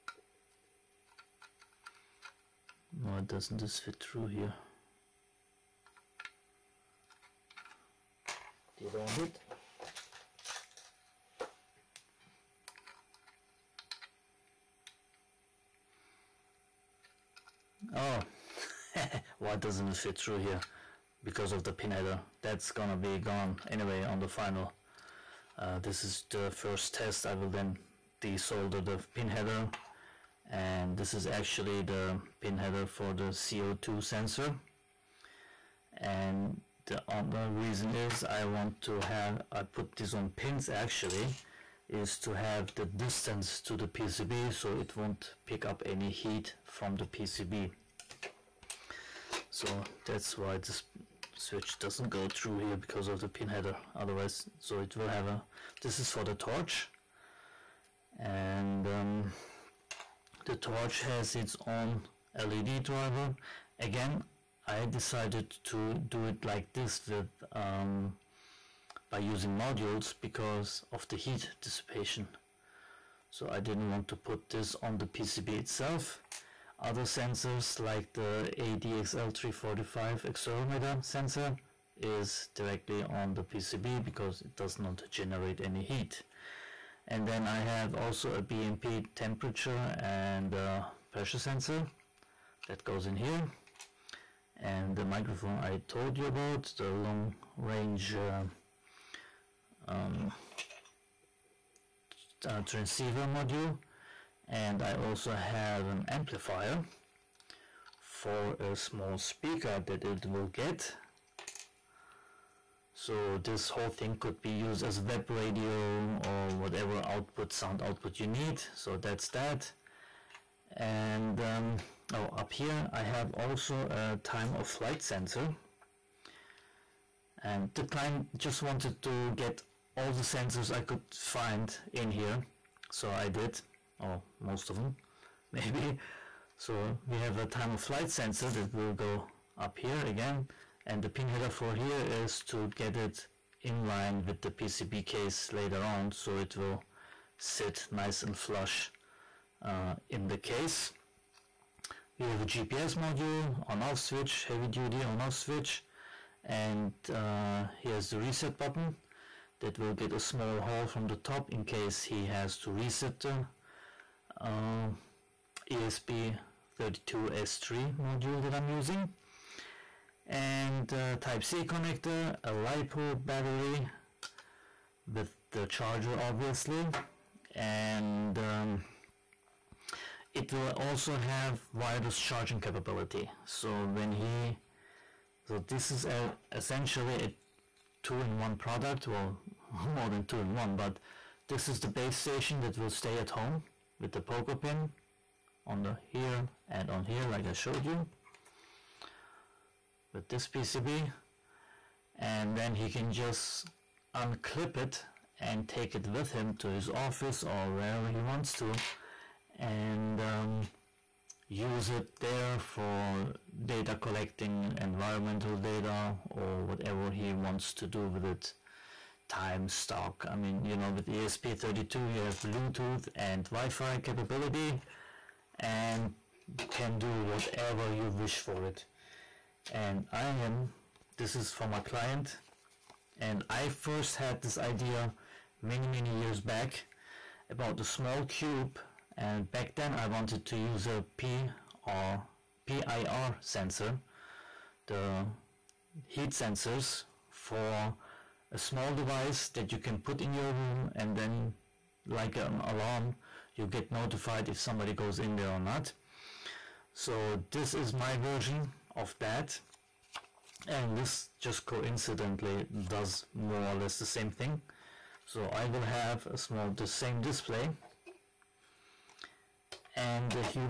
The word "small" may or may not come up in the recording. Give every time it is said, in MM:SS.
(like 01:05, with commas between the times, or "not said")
01:48, 02:40, 03:57, 04:08, 04:26.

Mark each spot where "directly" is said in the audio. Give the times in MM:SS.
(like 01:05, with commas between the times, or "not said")
01:22.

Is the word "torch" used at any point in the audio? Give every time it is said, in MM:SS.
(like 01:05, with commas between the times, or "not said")
00:56, 01:00.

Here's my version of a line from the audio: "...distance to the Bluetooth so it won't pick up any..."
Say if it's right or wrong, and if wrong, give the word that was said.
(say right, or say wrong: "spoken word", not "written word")
wrong: "PCB", not "Bluetooth".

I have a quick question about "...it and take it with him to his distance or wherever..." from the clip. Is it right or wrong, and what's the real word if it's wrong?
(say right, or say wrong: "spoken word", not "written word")
wrong: "office", not "distance".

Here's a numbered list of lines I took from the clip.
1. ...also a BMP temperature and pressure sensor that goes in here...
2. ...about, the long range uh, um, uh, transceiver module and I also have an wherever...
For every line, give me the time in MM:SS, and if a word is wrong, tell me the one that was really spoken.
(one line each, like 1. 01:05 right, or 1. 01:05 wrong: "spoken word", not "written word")
1. 01:27 right
2. 01:36 wrong: "amplifier", not "wherever".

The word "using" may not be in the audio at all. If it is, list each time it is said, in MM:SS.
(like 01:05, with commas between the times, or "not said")
01:09, 02:48.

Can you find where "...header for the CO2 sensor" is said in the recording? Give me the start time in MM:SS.
00:32.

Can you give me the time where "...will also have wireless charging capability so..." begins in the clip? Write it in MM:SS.
03:00.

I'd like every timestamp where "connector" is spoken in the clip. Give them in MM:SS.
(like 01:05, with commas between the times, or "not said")
02:51.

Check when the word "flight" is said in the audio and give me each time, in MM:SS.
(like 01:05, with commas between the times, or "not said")
02:04, 02:17.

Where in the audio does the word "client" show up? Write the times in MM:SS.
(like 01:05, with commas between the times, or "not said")
02:07, 03:51.